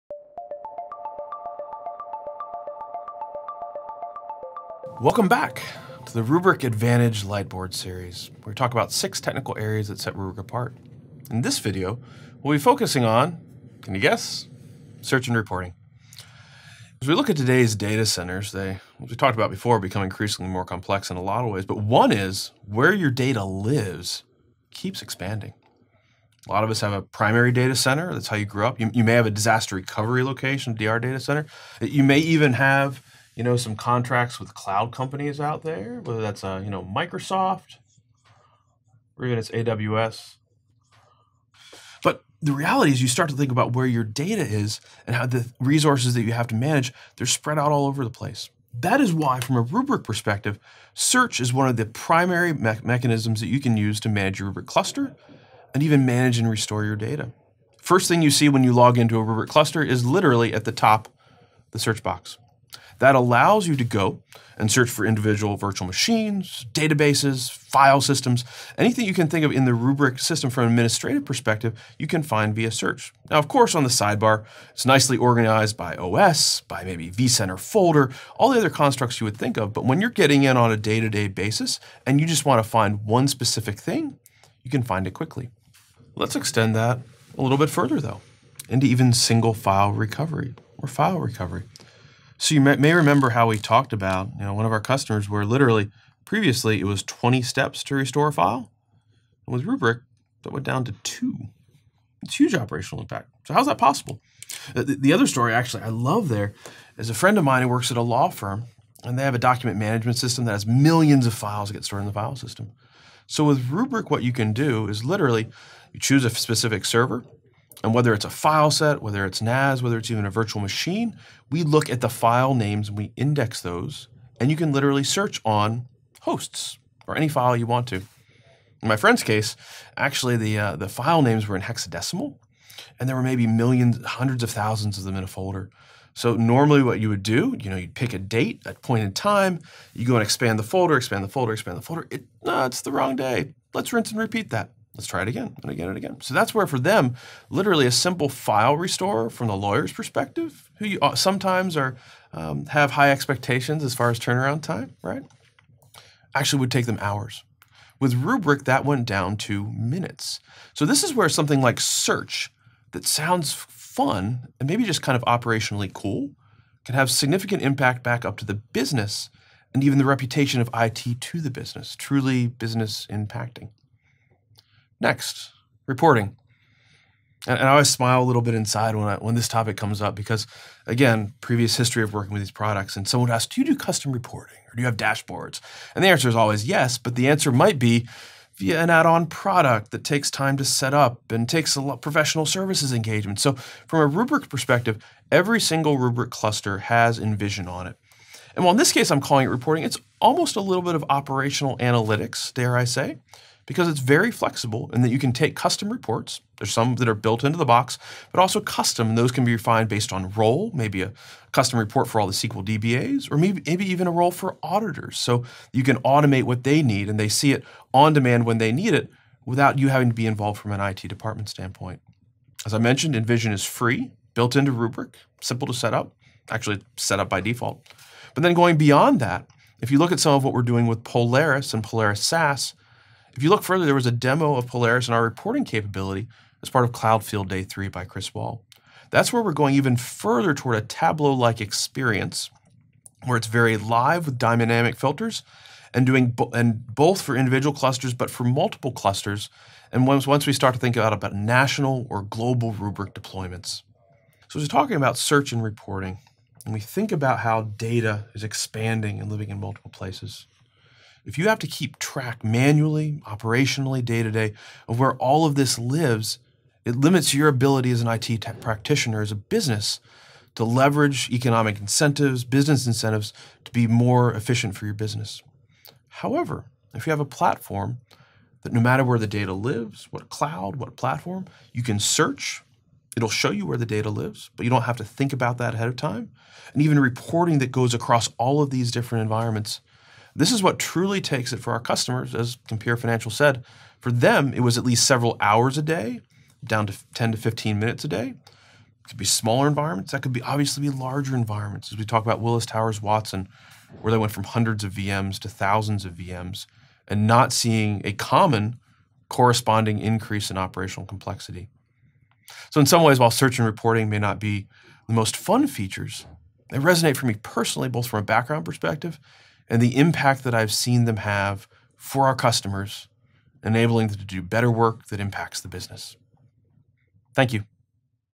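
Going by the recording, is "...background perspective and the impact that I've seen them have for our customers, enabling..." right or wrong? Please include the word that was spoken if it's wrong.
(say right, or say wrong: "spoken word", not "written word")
right.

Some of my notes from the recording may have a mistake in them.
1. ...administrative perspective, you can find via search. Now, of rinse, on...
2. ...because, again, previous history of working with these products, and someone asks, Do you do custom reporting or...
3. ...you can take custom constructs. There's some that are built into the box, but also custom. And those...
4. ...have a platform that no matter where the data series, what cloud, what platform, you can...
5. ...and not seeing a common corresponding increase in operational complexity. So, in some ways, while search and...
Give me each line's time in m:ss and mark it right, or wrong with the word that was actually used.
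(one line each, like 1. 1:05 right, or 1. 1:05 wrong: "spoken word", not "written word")
1. 1:10 wrong: "course", not "rinse"
2. 3:00 right
3. 3:25 wrong: "reports", not "constructs"
4. 4:37 wrong: "lives", not "series"
5. 5:07 right.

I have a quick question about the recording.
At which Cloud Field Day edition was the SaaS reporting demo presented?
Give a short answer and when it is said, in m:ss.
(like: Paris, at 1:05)
Cloud Field Day 3, at 3:56.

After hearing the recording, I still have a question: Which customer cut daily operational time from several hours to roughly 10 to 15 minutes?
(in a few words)
Compare Financial.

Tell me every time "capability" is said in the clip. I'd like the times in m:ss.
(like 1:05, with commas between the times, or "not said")
3:55.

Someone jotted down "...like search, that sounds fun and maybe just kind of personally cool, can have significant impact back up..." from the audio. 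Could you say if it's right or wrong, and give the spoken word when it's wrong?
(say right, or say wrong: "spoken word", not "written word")
wrong: "operationally", not "personally".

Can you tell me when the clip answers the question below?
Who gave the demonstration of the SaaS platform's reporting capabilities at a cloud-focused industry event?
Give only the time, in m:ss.
3:58.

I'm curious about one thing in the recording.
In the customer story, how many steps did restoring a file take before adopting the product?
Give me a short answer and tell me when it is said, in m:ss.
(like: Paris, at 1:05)
20, at 1:37.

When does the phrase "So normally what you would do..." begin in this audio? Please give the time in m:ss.
2:16.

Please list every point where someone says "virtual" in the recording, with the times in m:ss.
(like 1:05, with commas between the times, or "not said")
1:05, 2:00.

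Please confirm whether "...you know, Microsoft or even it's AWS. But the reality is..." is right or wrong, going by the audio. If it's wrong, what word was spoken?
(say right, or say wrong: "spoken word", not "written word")
right.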